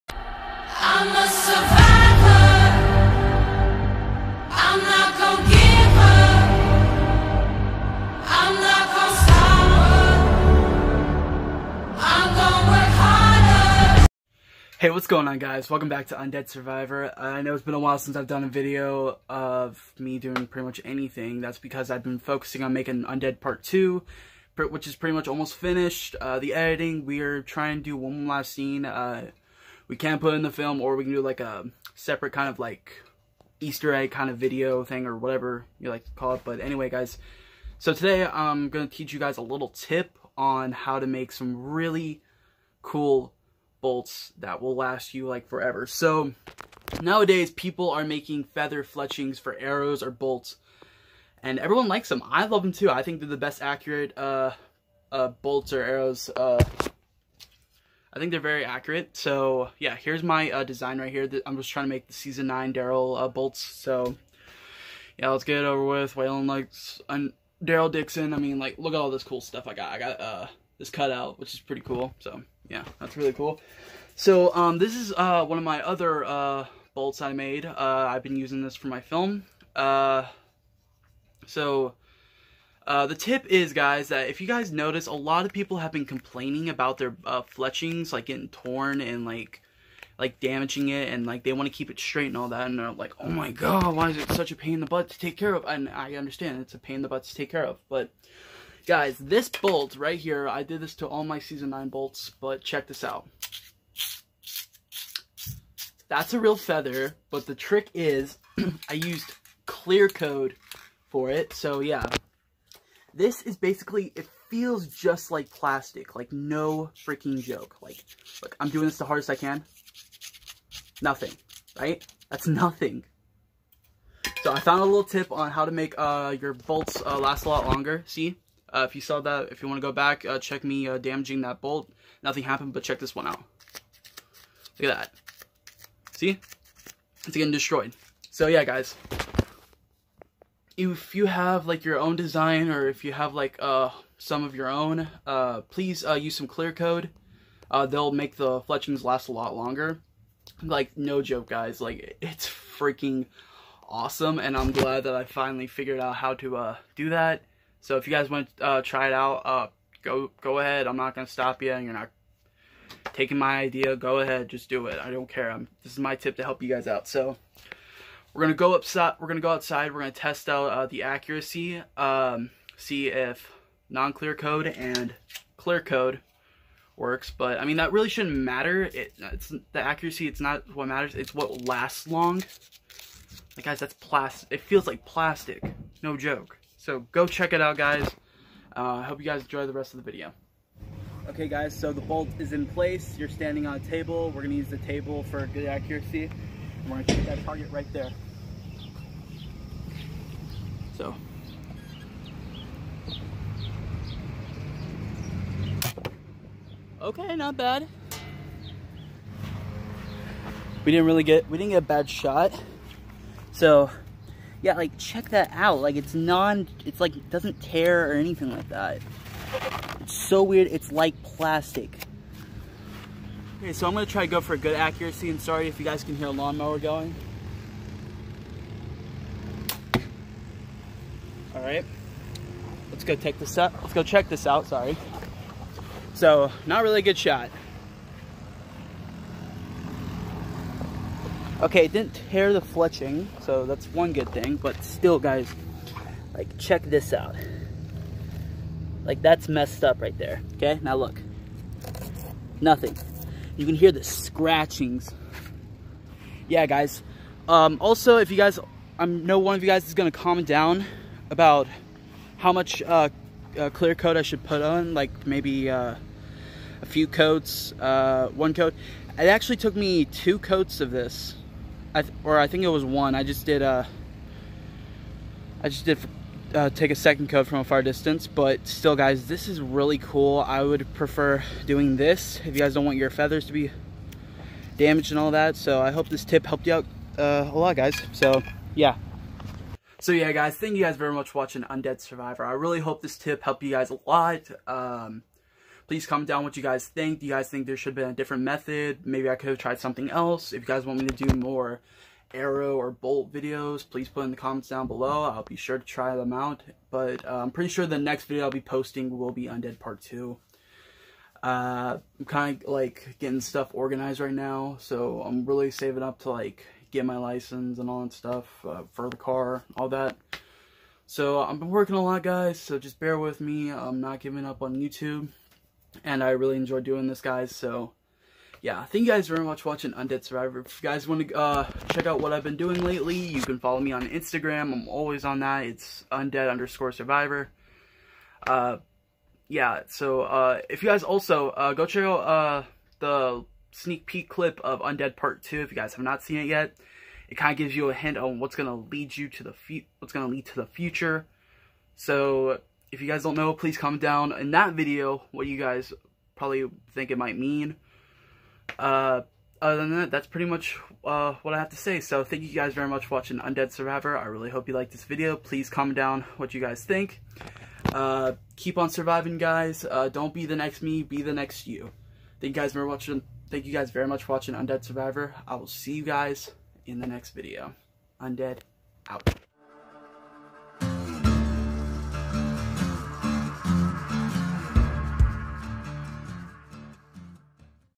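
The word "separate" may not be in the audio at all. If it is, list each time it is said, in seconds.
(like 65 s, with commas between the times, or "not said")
31 s.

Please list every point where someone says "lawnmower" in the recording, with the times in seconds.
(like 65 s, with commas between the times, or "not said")
226 s.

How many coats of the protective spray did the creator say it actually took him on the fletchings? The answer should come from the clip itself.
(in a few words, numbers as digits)
2.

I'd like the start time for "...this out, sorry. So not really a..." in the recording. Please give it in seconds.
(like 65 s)
234 s.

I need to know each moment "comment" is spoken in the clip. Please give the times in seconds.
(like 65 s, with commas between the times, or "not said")
260 s, 296 s, 304 s, 353 s, 365 s.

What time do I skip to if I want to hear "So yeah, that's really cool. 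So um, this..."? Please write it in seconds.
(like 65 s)
72 s.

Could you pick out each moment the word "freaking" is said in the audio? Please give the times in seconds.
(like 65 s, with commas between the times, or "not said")
117 s, 152 s.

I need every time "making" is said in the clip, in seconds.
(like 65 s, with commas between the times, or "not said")
22 s, 48 s.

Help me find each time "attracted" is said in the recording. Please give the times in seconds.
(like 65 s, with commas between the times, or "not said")
not said.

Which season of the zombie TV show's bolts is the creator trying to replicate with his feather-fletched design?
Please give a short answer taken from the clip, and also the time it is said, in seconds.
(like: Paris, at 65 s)
Season 9, at 62 s.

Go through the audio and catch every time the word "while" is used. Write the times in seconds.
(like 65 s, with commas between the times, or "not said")
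17 s.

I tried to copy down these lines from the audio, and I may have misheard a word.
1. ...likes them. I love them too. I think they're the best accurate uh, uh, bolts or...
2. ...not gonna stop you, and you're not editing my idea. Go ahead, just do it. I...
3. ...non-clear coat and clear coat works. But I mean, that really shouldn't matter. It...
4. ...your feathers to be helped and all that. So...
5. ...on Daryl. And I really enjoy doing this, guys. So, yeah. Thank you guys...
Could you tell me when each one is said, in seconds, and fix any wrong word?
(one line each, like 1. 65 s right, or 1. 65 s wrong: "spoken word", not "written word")
1. 51 s right
2. 160 s wrong: "taking", not "editing"
3. 173 s right
4. 282 s wrong: "damaged", not "helped"
5. 324 s wrong: "YouTube", not "Daryl".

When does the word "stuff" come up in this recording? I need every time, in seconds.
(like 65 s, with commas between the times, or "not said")
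69 s, 313 s, 318 s.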